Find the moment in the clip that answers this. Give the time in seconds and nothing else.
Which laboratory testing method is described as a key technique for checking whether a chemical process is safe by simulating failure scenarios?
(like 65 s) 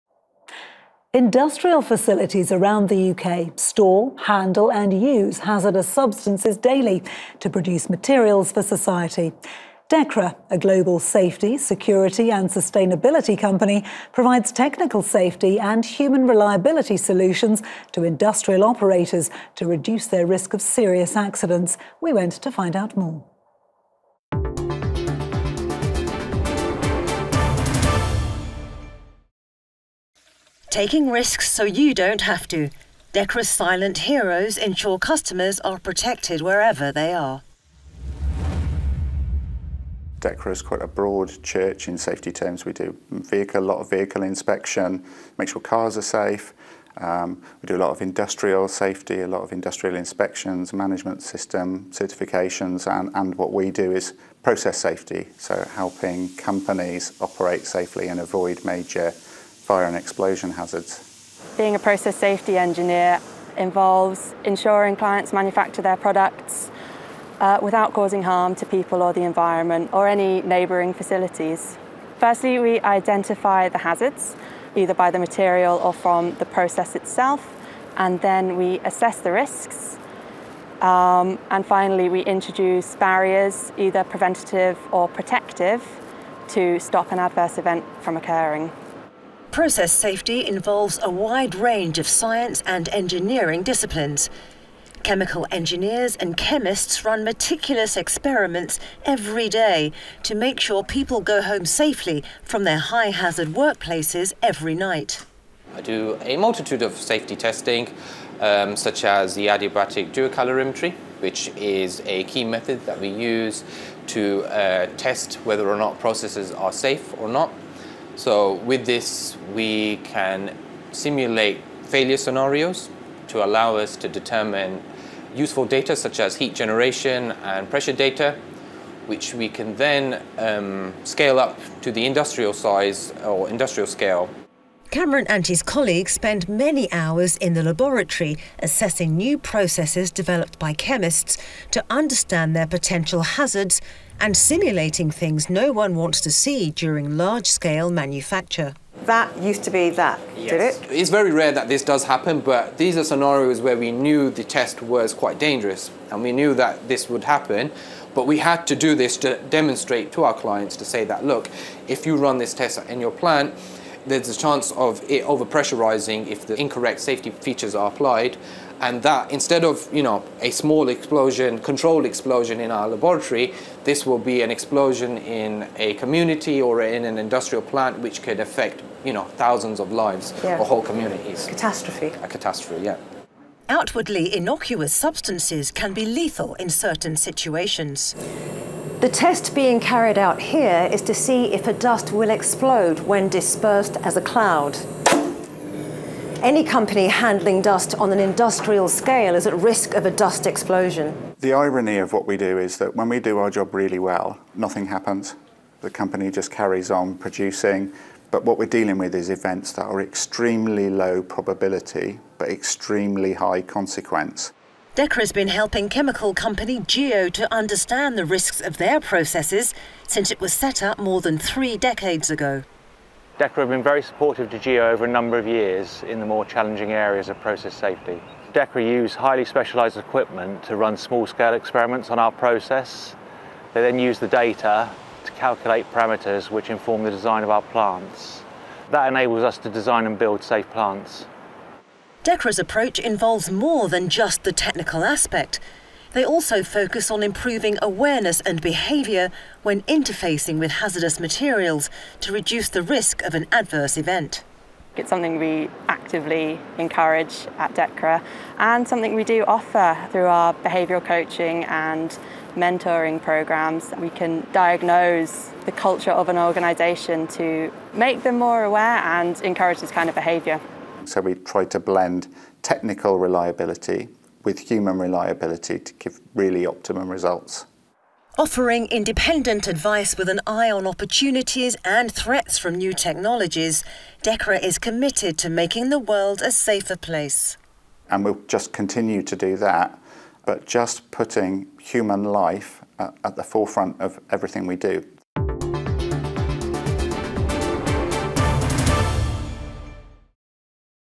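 109 s.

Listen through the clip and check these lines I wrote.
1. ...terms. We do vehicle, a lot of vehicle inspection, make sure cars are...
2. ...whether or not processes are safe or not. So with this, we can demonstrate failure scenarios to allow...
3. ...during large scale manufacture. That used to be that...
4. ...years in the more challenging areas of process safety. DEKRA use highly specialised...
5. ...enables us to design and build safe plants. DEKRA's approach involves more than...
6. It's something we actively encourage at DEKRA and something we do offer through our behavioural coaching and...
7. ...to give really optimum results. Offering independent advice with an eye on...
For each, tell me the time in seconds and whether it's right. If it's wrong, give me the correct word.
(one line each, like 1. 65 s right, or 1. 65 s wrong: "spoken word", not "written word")
1. 42 s right
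2. 115 s wrong: "simulate", not "demonstrate"
3. 146 s right
4. 225 s right
5. 239 s right
6. 254 s right
7. 275 s right.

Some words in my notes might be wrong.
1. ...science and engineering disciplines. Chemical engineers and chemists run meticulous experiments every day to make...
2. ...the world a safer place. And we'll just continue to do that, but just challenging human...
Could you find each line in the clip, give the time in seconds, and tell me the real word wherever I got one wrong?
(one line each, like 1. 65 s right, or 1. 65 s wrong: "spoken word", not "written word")
1. 92 s right
2. 285 s wrong: "putting", not "challenging".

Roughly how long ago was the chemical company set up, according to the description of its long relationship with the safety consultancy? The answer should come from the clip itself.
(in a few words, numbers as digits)
More than three decades.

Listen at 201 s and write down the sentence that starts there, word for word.
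The irony of what we do is that when we do our job really well, nothing happens.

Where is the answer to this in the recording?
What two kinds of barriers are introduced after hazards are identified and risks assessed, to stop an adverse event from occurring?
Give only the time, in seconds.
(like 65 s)
84 s.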